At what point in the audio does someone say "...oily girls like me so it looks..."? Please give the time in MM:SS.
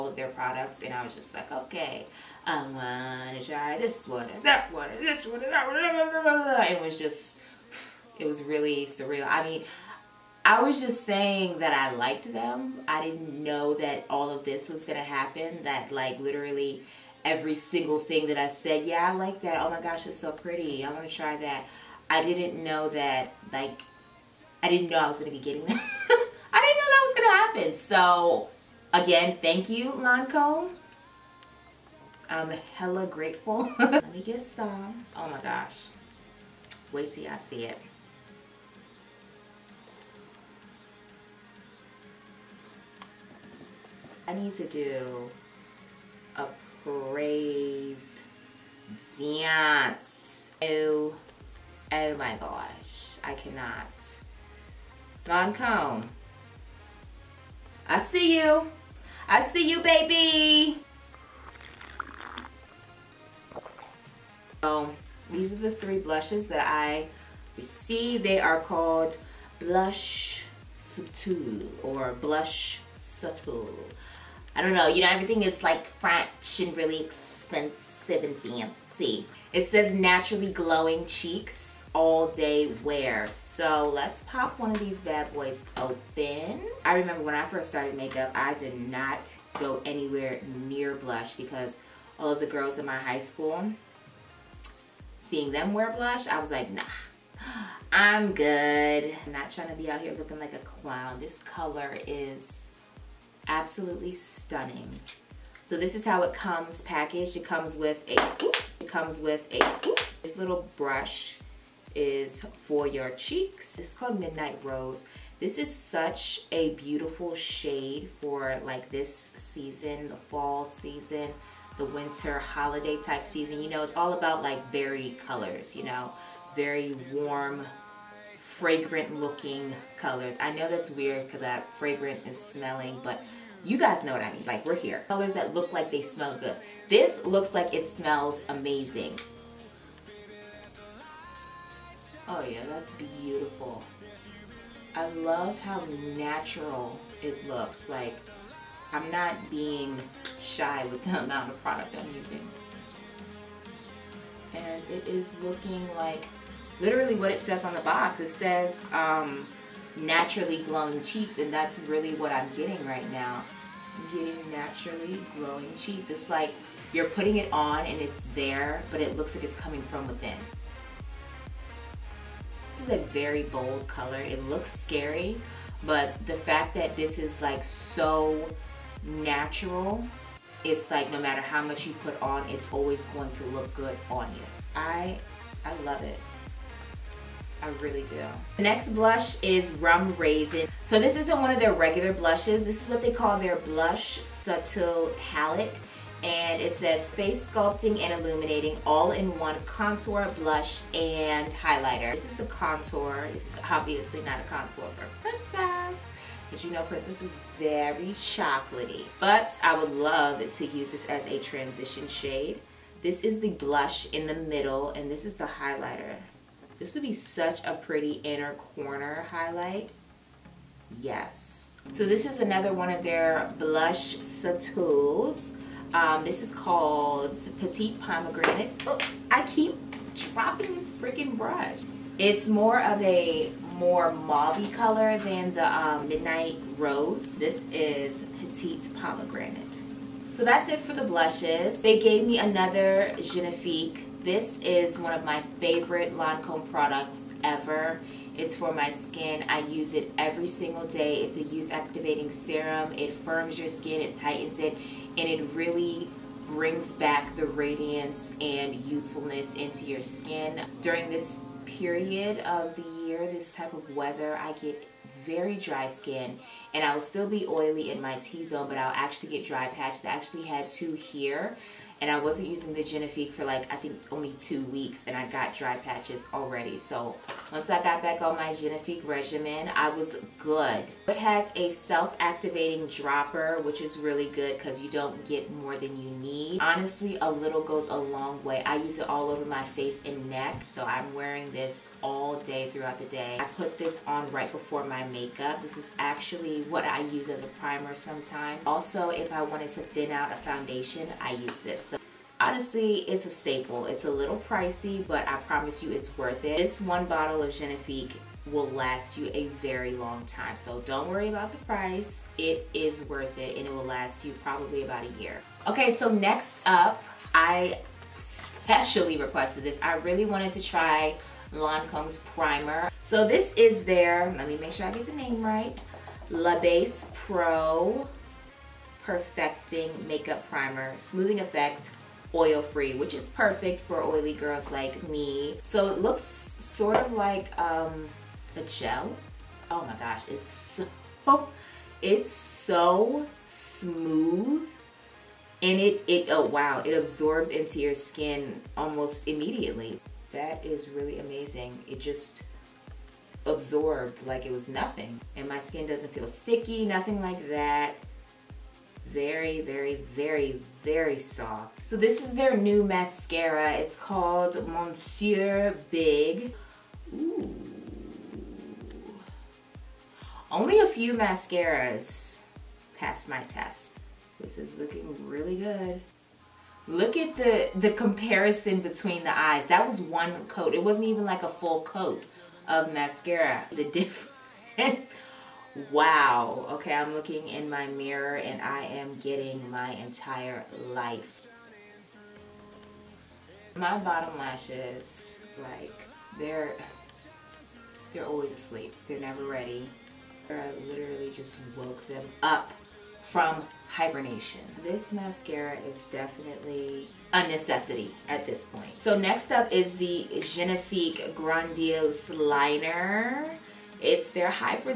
05:34.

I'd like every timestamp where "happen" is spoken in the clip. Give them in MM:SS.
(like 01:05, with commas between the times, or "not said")
00:15, 00:27.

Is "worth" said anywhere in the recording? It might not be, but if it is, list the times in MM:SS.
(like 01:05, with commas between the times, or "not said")
05:06, 05:13.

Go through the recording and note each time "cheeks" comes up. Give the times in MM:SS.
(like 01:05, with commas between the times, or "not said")
01:21, 01:53, 02:41, 02:45.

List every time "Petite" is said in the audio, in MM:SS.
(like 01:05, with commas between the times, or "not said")
03:47, 03:58.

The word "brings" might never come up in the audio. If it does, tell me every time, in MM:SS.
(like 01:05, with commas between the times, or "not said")
04:16.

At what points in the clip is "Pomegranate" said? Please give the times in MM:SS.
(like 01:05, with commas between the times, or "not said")
03:48, 03:58.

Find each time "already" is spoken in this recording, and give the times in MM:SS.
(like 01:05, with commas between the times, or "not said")
04:36.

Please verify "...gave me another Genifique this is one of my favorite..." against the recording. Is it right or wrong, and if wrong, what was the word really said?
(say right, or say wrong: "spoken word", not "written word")
right.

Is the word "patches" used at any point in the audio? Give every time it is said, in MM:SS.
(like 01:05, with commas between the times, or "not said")
04:29, 04:35.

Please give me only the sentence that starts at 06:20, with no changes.
It wasn't even like a full coat of mascara.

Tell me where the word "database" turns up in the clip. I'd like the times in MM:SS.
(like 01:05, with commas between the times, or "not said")
not said.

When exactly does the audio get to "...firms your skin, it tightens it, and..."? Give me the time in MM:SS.
04:13.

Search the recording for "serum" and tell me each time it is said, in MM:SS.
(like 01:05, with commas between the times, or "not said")
04:12.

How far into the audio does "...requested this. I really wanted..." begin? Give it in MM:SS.
05:19.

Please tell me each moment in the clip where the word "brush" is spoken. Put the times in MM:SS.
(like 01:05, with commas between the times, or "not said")
01:50, 03:51.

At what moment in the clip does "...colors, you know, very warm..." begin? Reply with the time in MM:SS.
02:05.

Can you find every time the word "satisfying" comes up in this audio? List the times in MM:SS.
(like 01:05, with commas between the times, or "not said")
not said.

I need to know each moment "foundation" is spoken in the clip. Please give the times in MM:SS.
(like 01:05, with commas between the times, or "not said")
05:00.